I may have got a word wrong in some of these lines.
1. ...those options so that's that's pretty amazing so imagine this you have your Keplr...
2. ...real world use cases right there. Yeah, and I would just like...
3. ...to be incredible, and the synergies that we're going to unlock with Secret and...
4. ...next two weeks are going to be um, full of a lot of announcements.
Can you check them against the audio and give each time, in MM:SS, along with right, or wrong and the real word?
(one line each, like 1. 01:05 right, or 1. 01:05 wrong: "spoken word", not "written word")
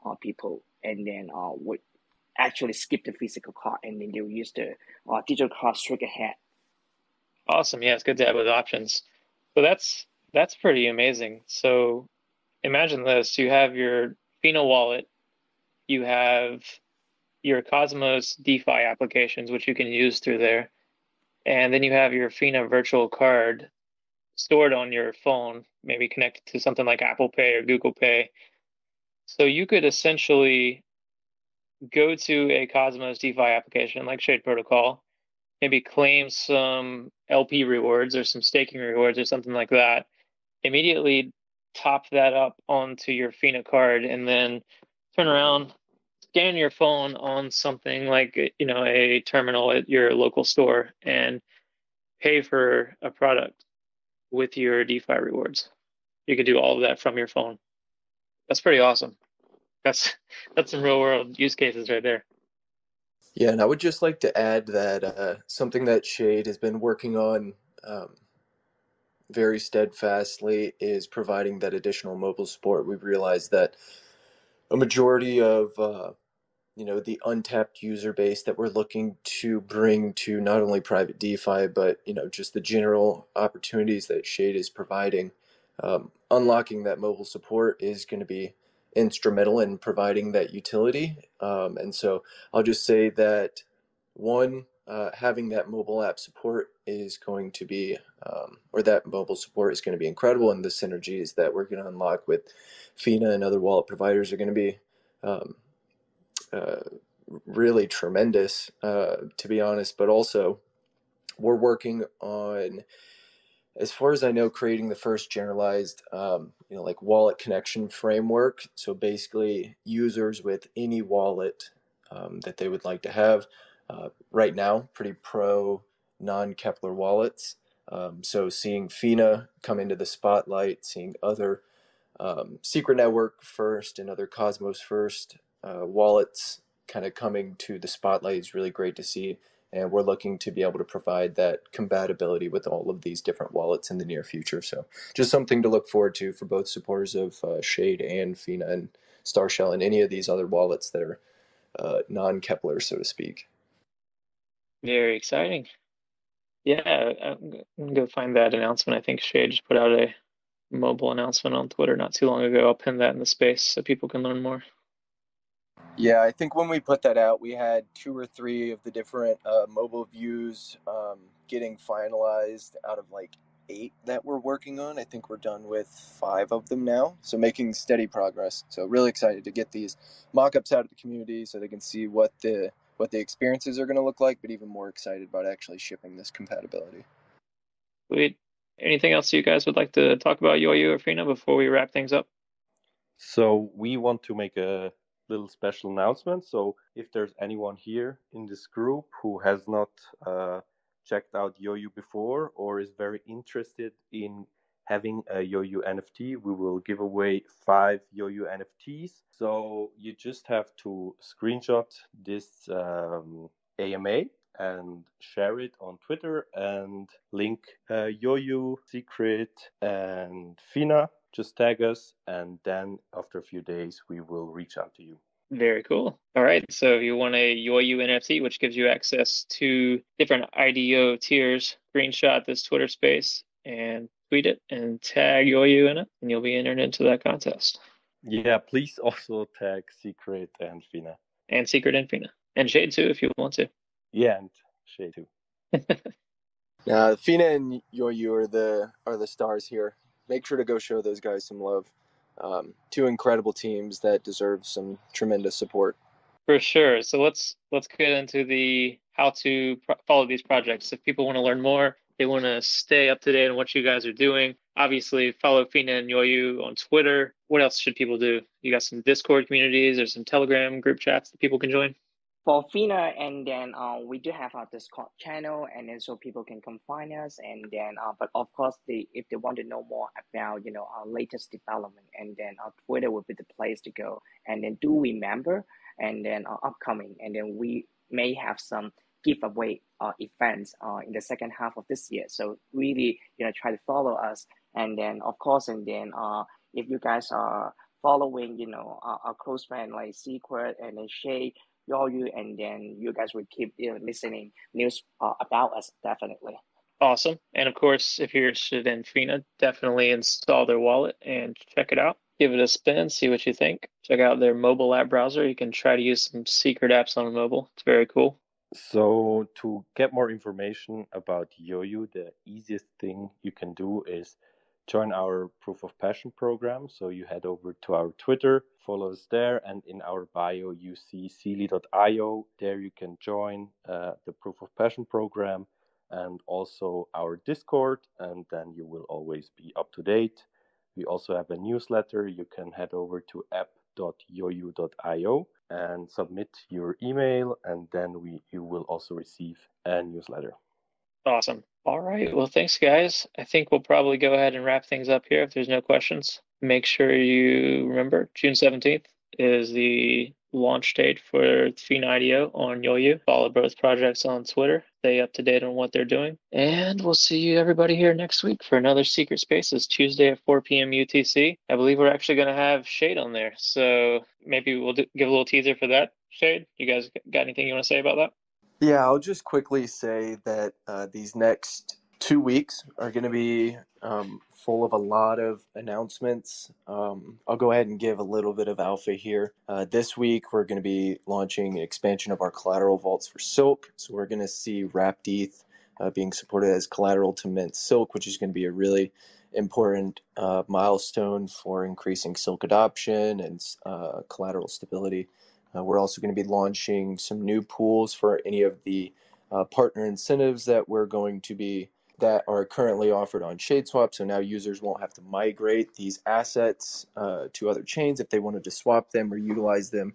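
1. 00:08 wrong: "Fina", not "Keplr"
2. 01:00 right
3. 01:39 wrong: "FINA", not "Secret"
4. 06:21 right.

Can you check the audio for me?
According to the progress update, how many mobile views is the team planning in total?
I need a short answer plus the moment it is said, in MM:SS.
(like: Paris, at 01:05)
8, at 02:53.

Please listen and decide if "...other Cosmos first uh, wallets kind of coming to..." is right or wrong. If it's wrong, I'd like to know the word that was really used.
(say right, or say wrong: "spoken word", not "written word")
right.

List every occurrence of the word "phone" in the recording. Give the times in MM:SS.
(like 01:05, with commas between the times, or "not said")
00:25, 00:46, 00:57.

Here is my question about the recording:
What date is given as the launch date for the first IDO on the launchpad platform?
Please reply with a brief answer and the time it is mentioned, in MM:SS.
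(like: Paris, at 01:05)
June 17th, at 05:58.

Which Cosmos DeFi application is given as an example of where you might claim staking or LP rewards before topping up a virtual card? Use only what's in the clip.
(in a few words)
Shade Protocol.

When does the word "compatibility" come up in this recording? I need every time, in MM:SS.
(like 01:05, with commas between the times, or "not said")
02:21, 03:06.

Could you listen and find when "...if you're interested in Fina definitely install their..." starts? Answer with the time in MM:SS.
05:08.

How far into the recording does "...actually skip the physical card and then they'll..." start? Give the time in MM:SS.
00:02.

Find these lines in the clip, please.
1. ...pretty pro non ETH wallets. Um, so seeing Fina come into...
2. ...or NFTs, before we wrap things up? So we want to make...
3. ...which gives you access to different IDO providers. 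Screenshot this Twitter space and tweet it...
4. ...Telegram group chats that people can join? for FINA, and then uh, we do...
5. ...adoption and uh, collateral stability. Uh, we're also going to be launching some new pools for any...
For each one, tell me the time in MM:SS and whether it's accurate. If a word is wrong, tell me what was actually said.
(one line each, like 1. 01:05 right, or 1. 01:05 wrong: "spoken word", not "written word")
1. 02:04 wrong: "Keplr", not "ETH"
2. 03:10 wrong: "Fina", not "NFTs"
3. 03:48 wrong: "tiers", not "providers"
4. 04:30 right
5. 06:42 right.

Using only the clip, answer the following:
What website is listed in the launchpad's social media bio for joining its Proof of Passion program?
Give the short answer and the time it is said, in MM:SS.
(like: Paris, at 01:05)
Zealy.io, at 05:31.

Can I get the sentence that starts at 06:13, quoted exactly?
So maybe we'll do, give a little teaser for that.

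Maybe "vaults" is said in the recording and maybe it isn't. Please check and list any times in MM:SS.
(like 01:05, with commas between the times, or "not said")
06:32.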